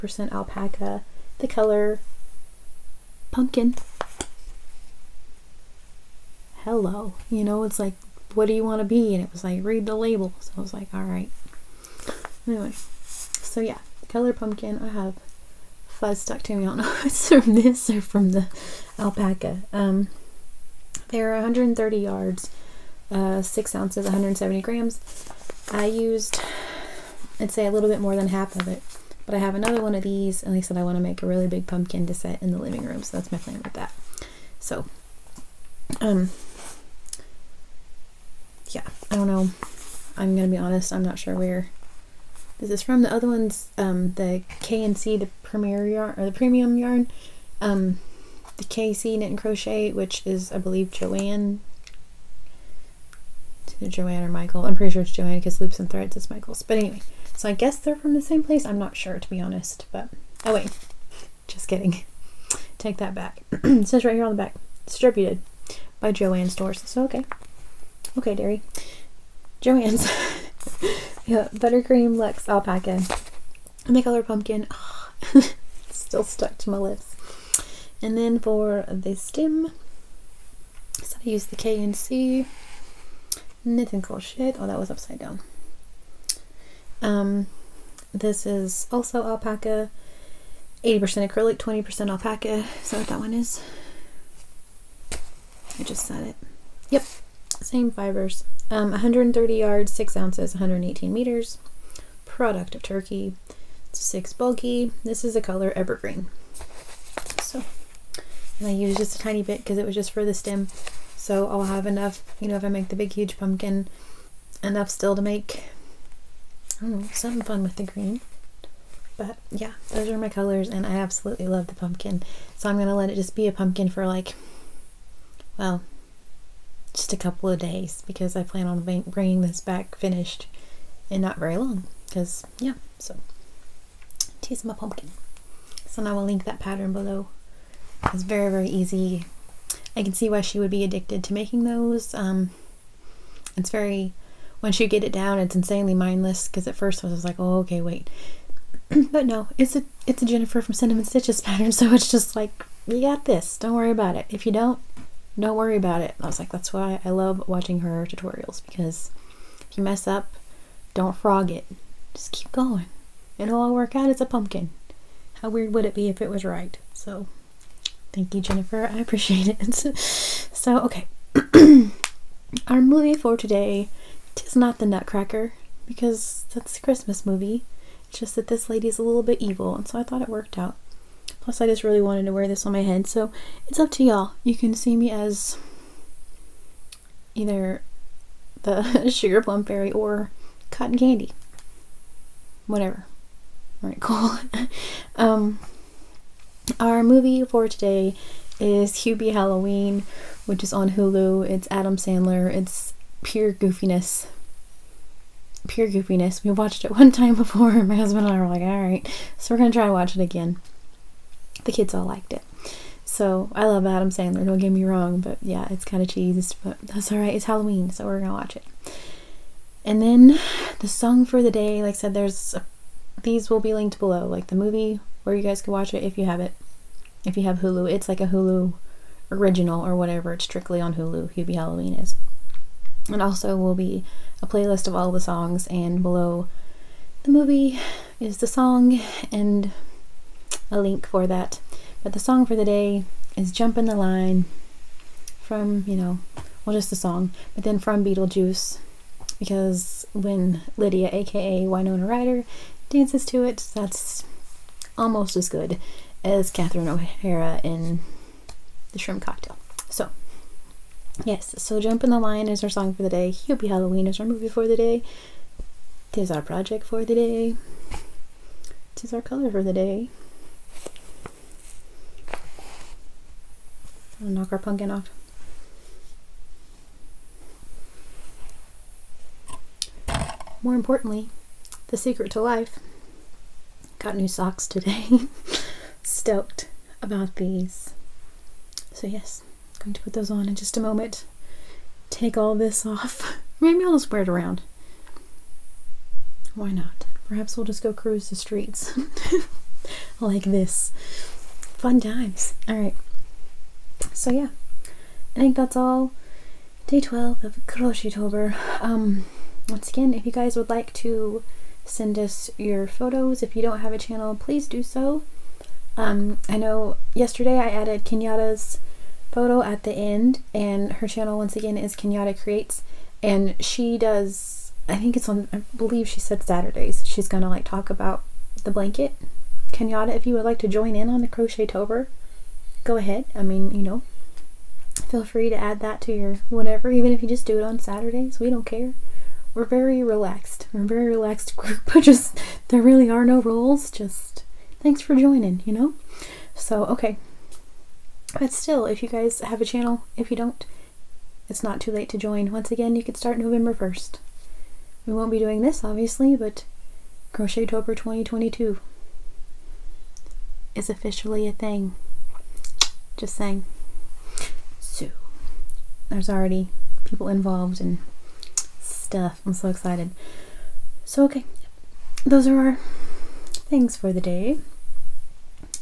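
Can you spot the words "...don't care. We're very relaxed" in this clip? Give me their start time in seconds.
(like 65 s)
338 s.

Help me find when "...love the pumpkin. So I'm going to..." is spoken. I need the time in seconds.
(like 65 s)
121 s.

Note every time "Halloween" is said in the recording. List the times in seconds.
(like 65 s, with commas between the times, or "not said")
199 s, 217 s, 231 s, 263 s.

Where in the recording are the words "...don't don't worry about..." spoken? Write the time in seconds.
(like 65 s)
154 s.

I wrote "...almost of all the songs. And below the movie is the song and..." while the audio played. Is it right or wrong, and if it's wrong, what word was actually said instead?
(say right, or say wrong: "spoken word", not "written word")
wrong: "playlist", not "almost".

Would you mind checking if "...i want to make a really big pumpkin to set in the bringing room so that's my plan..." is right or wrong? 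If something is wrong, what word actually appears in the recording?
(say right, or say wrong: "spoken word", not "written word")
wrong: "living", not "bringing".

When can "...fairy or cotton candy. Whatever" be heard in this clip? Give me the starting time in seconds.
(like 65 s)
189 s.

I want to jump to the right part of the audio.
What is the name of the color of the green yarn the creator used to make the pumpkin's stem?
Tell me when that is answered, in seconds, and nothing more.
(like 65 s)
105 s.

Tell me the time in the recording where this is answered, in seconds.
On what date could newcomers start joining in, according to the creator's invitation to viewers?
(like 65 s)
353 s.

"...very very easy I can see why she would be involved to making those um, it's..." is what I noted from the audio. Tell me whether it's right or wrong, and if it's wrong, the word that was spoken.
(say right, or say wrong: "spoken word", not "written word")
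wrong: "addicted", not "involved".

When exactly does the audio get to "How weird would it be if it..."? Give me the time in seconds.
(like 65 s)
165 s.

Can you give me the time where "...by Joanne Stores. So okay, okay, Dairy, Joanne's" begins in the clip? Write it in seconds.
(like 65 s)
65 s.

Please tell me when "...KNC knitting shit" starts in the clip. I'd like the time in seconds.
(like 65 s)
81 s.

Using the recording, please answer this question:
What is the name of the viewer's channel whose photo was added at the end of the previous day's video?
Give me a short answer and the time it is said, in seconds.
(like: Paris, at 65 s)
Kenyatta Creates, at 321 s.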